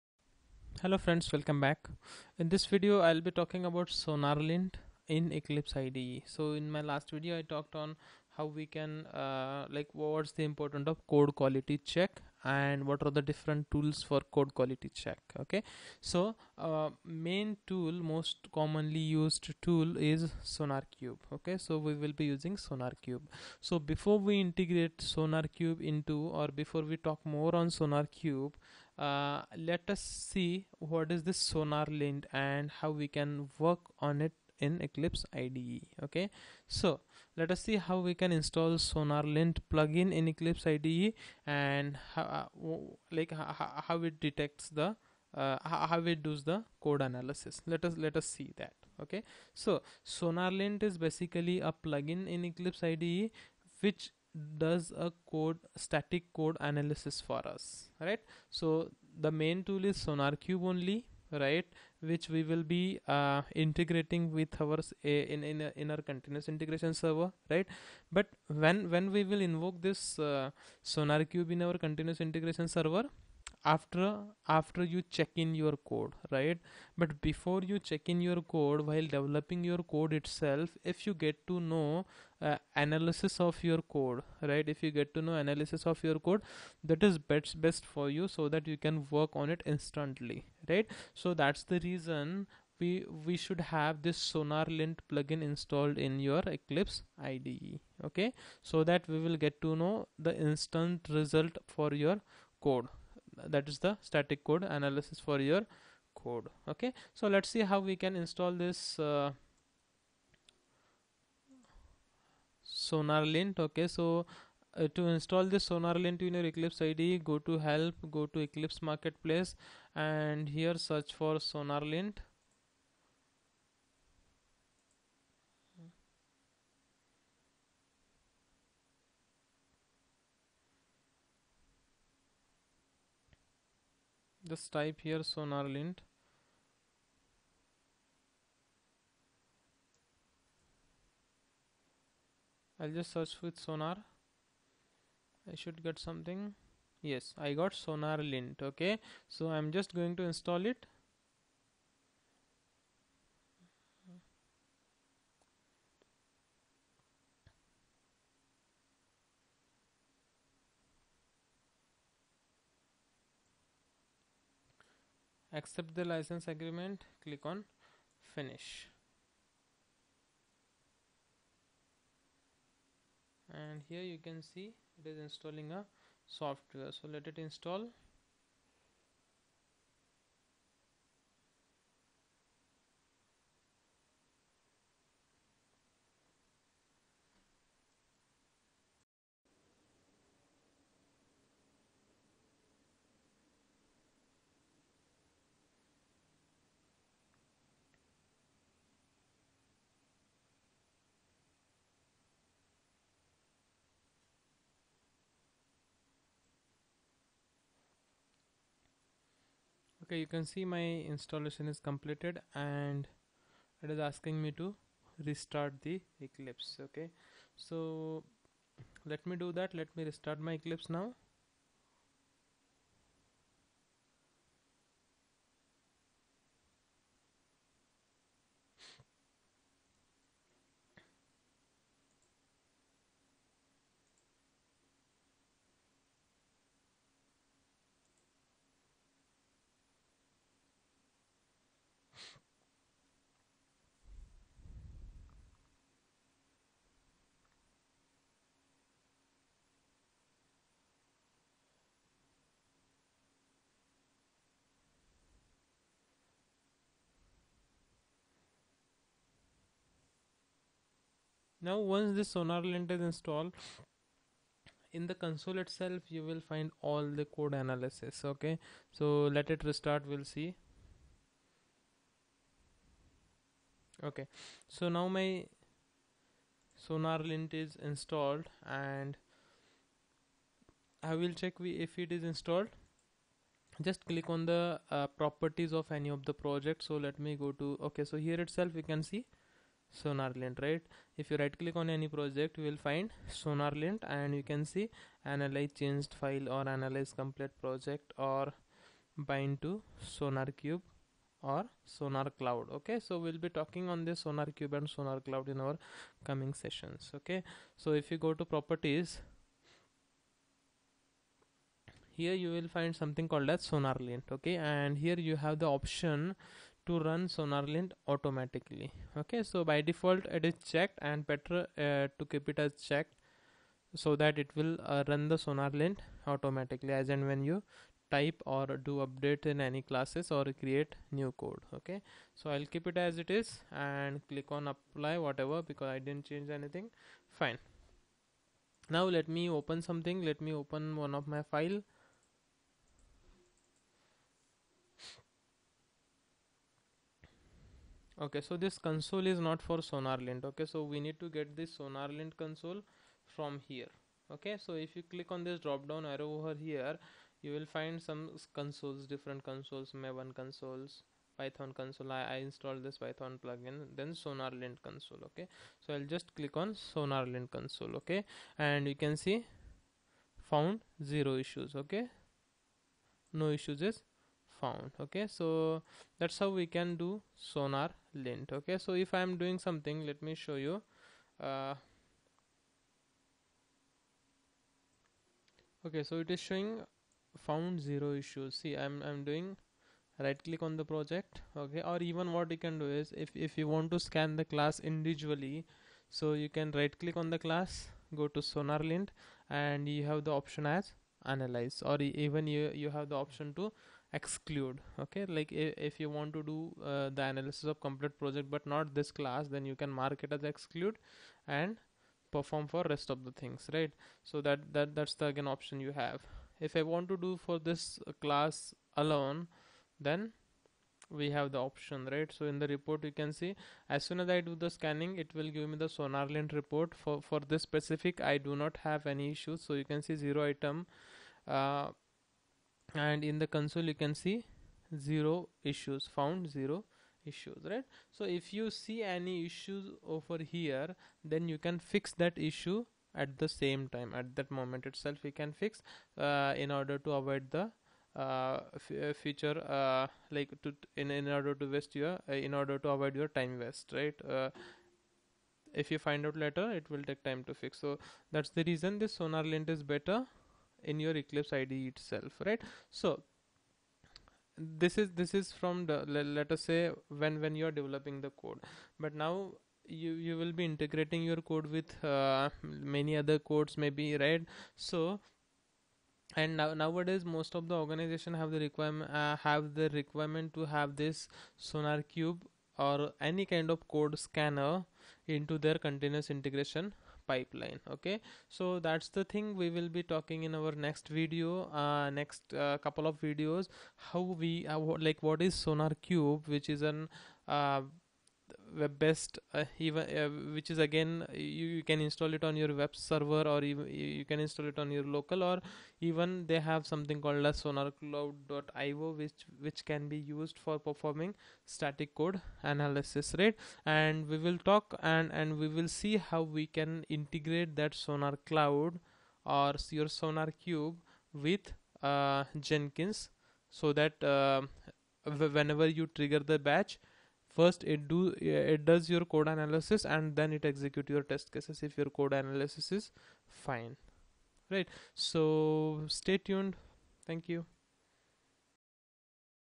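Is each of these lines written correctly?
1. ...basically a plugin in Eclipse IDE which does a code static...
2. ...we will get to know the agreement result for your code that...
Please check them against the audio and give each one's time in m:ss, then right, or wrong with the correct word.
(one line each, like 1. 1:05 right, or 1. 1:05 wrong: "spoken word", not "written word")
1. 0:50 right
2. 1:39 wrong: "instant", not "agreement".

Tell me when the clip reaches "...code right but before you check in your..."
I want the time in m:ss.
1:15.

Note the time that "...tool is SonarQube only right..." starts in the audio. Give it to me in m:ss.
0:59.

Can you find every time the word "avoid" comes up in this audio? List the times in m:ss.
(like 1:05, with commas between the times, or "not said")
7:27, 7:32.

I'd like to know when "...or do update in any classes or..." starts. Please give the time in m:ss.
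5:28.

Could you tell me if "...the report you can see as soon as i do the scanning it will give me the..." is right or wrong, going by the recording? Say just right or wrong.
right.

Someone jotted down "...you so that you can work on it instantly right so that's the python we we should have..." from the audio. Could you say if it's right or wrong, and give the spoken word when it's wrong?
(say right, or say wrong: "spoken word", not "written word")
wrong: "reason", not "python".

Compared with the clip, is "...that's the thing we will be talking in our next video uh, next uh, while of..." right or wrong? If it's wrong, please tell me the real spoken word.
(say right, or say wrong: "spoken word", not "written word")
wrong: "couple", not "while".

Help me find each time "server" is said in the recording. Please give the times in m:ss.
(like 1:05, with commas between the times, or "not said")
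1:06, 1:12, 8:22.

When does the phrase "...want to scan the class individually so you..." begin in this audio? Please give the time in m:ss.
6:33.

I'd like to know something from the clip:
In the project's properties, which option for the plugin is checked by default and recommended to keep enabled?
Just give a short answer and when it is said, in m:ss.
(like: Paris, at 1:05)
Run SonarLint automatically, at 5:16.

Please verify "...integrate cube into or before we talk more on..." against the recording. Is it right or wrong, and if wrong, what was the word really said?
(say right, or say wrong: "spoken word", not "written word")
right.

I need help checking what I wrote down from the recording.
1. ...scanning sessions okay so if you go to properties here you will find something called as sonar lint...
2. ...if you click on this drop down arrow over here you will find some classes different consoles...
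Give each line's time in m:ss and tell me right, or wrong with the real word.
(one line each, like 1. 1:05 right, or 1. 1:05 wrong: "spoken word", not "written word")
1. 5:06 wrong: "coming", not "scanning"
2. 5:54 wrong: "consoles", not "classes".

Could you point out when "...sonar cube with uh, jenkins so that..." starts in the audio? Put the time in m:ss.
8:40.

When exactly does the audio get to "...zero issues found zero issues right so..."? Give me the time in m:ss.
7:14.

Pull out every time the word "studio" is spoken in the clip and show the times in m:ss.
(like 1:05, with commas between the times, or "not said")
not said.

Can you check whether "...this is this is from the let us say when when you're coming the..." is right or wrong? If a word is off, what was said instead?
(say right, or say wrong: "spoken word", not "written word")
wrong: "developing", not "coming".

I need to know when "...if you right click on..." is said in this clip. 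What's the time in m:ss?
4:51.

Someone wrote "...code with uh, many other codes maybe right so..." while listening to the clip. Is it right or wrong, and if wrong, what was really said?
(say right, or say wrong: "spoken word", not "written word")
right.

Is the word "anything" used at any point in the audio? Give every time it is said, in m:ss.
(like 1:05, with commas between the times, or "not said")
5:36.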